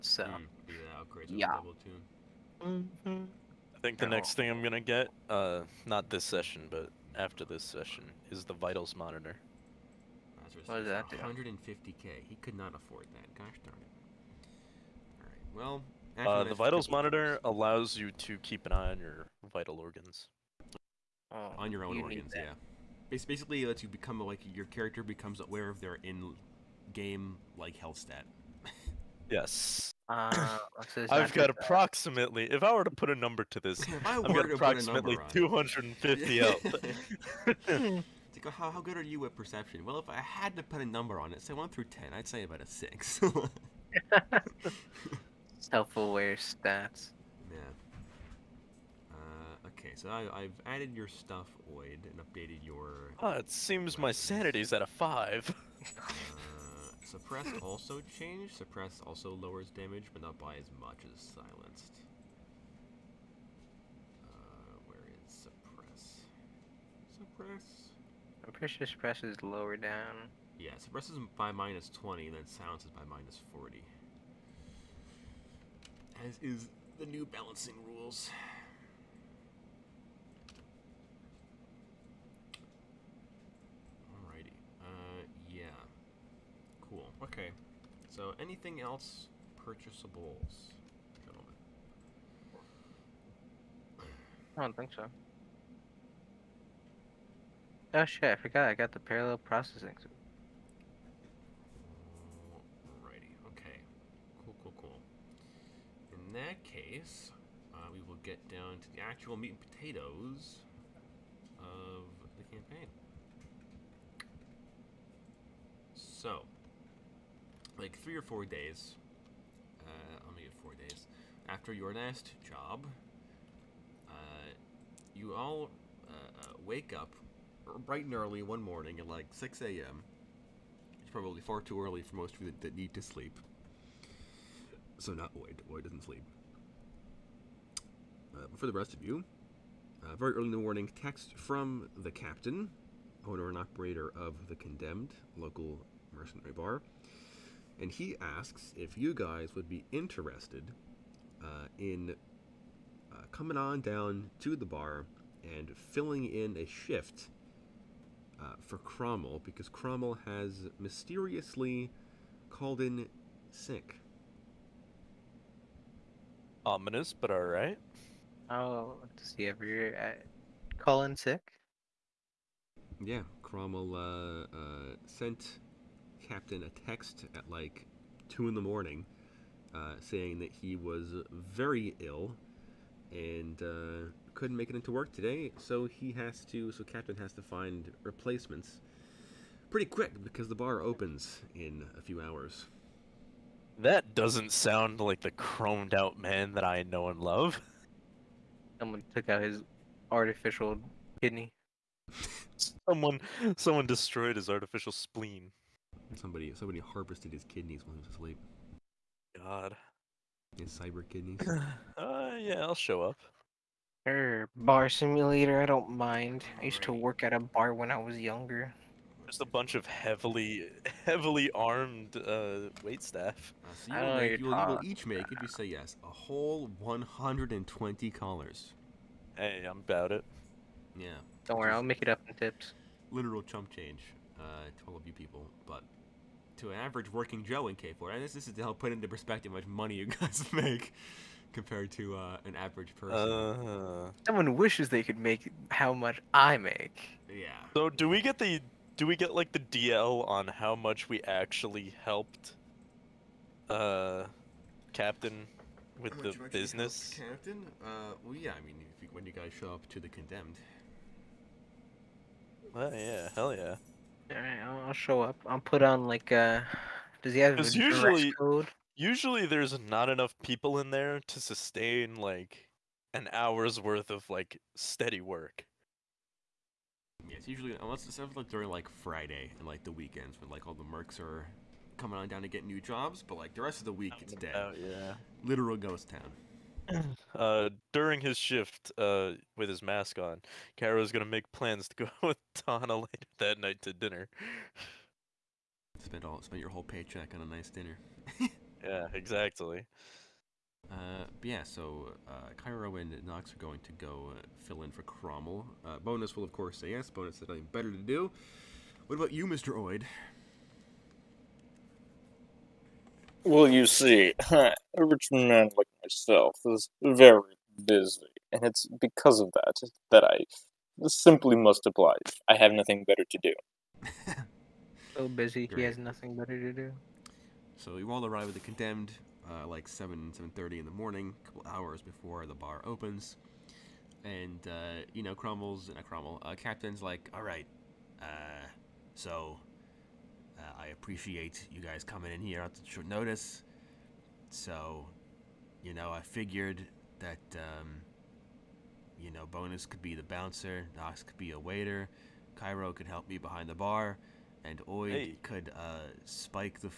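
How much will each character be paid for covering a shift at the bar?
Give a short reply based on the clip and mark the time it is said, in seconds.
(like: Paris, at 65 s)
120 collars, at 226 s.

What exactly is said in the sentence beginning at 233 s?
Literal chump change uh, to all of you people, but to an average working Joe in K4.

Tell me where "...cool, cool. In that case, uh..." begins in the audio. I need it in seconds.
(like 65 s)
104 s.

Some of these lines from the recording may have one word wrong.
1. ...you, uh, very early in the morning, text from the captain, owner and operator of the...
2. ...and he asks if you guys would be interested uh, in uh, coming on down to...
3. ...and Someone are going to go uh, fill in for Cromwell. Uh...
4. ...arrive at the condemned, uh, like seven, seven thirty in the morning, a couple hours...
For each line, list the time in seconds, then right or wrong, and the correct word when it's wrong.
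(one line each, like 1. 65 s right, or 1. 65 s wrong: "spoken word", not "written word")
1. 139 s right
2. 147 s right
3. 302 s wrong: "Knox", not "Someone"
4. 328 s right.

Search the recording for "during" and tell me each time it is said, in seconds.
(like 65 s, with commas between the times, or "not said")
278 s, 287 s.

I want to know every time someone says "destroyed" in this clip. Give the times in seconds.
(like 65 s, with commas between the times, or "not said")
203 s.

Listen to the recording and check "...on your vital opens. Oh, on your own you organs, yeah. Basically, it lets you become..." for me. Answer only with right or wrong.
wrong.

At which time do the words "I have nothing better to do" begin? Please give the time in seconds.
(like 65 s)
322 s.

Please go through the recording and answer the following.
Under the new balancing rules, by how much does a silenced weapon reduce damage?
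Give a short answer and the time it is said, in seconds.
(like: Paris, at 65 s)
minus 40, at 73 s.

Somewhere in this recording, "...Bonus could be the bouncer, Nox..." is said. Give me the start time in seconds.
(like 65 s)
349 s.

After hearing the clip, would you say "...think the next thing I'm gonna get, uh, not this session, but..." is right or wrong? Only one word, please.
right.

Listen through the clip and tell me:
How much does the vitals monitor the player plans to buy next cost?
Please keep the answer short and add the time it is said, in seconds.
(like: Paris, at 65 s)
150k, at 11 s.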